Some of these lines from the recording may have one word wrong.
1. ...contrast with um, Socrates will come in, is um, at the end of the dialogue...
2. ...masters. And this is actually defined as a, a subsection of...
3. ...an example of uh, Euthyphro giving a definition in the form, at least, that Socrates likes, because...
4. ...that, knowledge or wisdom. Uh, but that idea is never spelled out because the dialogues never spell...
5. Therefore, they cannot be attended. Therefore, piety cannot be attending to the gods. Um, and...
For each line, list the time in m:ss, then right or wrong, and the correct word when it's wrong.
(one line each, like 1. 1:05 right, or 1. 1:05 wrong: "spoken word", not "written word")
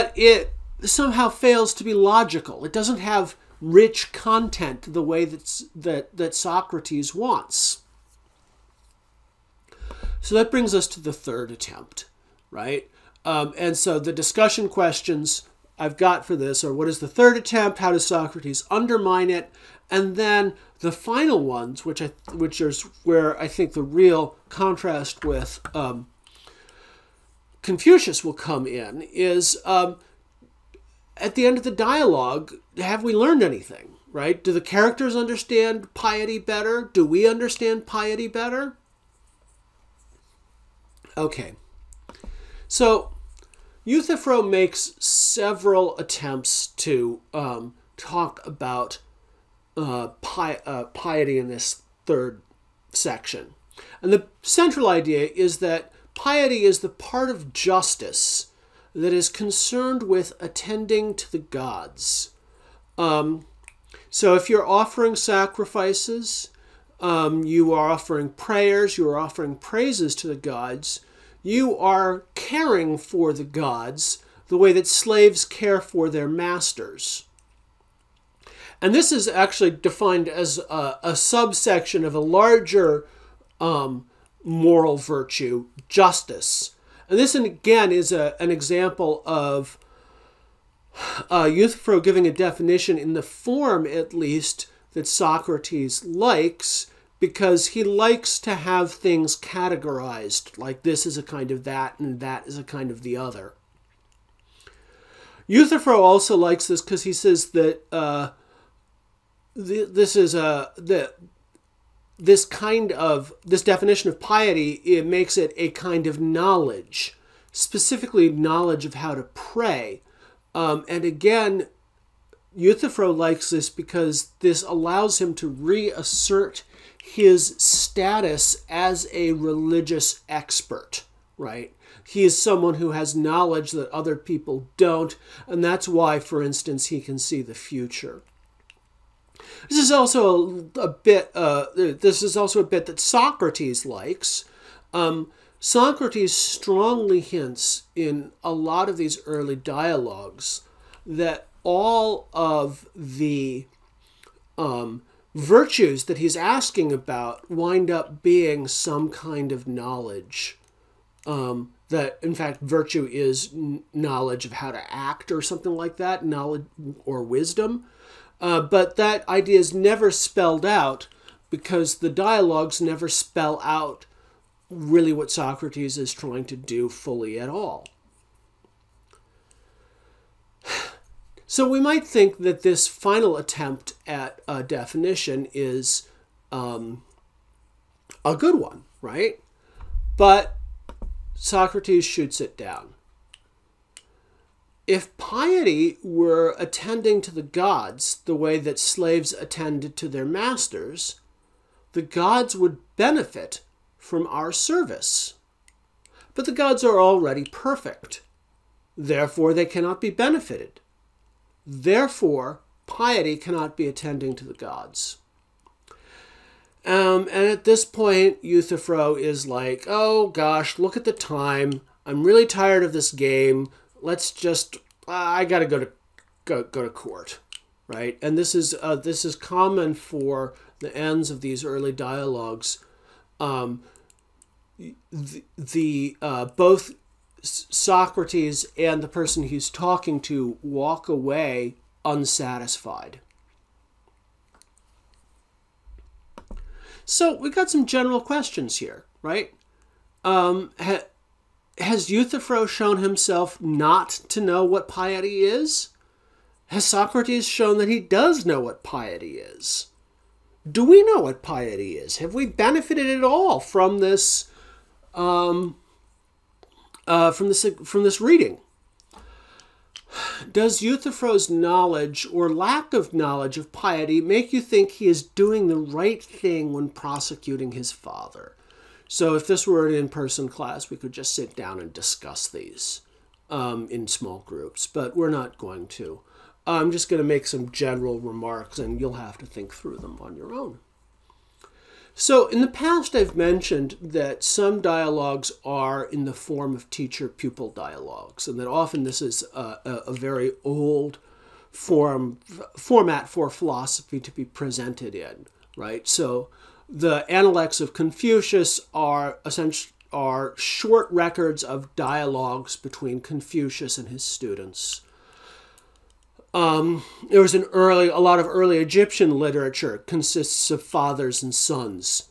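1. 0:24 wrong: "Confucius", not "Socrates"
2. 1:16 right
3. 1:28 right
4. 2:45 right
5. 3:28 wrong: "benefited", not "attended".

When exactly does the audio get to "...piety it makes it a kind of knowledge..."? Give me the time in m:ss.
1:54.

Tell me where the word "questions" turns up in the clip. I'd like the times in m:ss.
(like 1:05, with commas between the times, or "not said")
0:14, 4:08.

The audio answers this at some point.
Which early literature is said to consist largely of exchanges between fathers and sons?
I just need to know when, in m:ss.
5:18.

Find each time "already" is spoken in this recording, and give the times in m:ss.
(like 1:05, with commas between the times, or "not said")
3:26.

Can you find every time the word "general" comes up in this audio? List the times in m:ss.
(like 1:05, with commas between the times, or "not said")
4:07, 4:47.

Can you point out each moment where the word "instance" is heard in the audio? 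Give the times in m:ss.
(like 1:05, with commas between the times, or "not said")
2:16.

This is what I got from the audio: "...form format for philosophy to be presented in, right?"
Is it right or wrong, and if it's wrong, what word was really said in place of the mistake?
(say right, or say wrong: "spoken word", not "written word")
right.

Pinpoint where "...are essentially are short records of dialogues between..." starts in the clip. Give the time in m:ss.
5:08.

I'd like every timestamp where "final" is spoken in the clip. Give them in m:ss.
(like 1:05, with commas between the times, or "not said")
0:20, 3:02.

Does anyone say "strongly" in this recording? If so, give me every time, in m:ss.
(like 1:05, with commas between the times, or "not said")
2:26.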